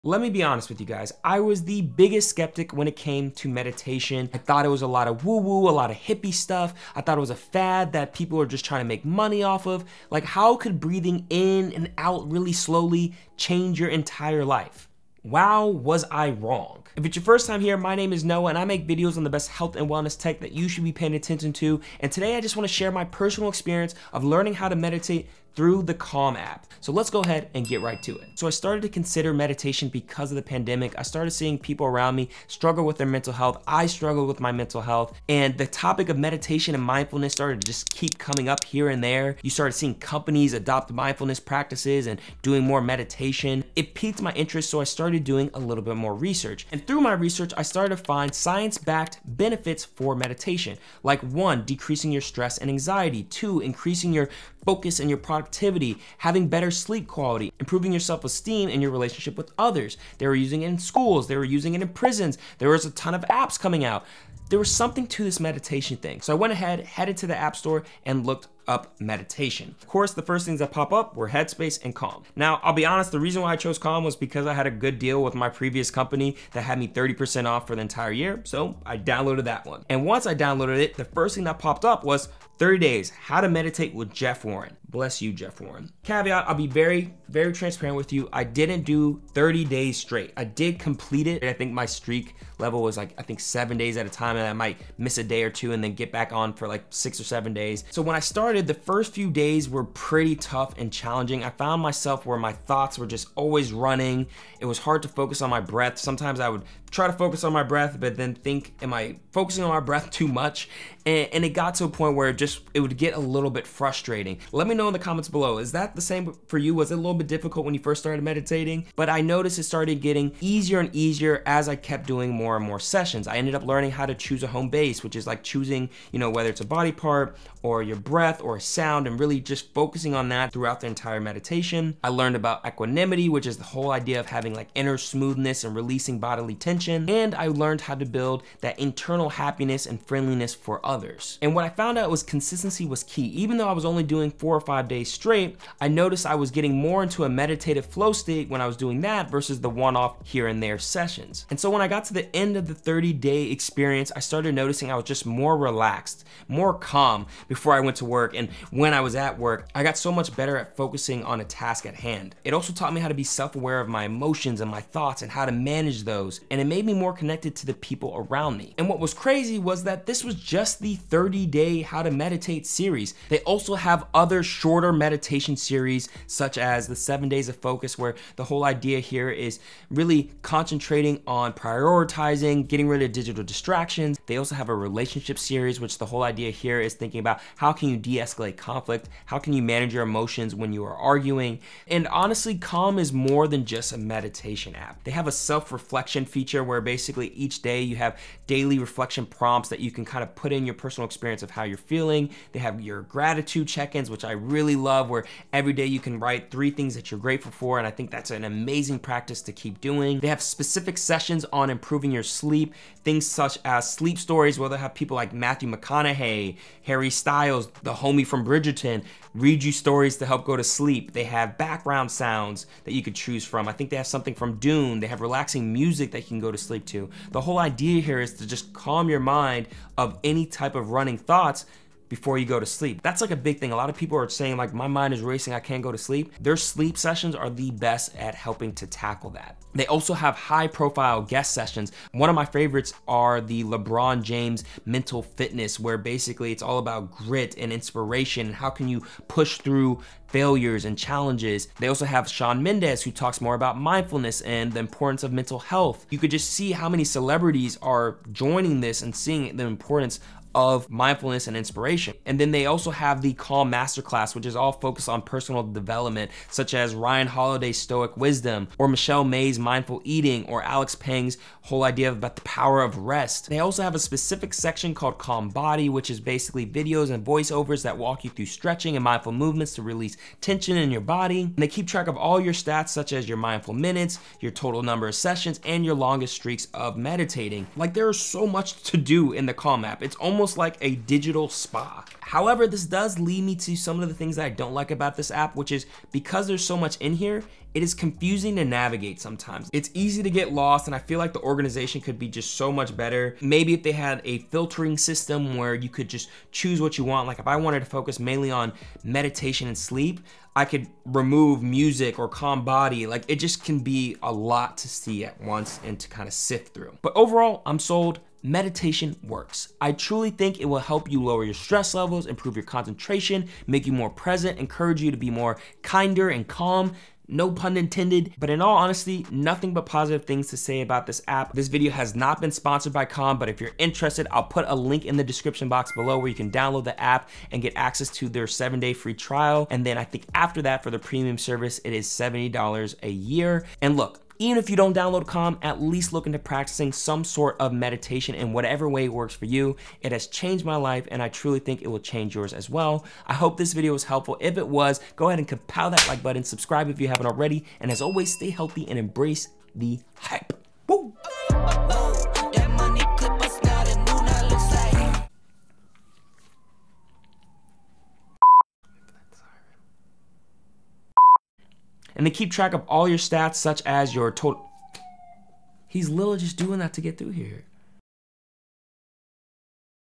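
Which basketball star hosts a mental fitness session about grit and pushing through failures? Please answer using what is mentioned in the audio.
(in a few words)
LeBron James.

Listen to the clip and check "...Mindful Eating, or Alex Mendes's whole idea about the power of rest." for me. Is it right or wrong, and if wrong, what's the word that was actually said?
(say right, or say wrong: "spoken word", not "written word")
wrong: "Pang", not "Mendes".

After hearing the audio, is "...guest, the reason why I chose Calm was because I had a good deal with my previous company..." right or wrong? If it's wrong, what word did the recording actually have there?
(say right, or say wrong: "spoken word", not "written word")
wrong: "honest", not "guest".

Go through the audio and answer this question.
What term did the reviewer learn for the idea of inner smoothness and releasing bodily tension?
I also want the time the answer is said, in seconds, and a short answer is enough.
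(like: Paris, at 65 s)
equanimity, at 132 s.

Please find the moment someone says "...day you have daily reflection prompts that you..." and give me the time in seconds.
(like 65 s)
197 s.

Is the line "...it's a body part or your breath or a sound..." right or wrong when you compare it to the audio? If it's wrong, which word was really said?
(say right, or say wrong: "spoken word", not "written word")
right.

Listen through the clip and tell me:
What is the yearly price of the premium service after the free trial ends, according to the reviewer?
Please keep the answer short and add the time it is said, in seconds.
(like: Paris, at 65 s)
$70, at 342 s.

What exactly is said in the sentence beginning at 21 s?
And today I just wanna share my personal experience of learning how to meditate through the Calm app.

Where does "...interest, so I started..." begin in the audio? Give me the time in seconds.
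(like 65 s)
44 s.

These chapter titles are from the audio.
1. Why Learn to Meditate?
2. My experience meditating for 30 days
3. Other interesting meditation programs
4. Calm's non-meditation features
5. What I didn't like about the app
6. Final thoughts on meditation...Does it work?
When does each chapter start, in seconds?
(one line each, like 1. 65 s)
1. 44 s
2. 95 s
3. 189 s
4. 208 s
5. 308 s
6. 332 s.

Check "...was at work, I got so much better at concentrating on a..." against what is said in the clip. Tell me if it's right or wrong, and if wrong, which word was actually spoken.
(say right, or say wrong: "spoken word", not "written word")
wrong: "focusing", not "concentrating".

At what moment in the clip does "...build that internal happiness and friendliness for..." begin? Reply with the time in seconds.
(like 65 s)
138 s.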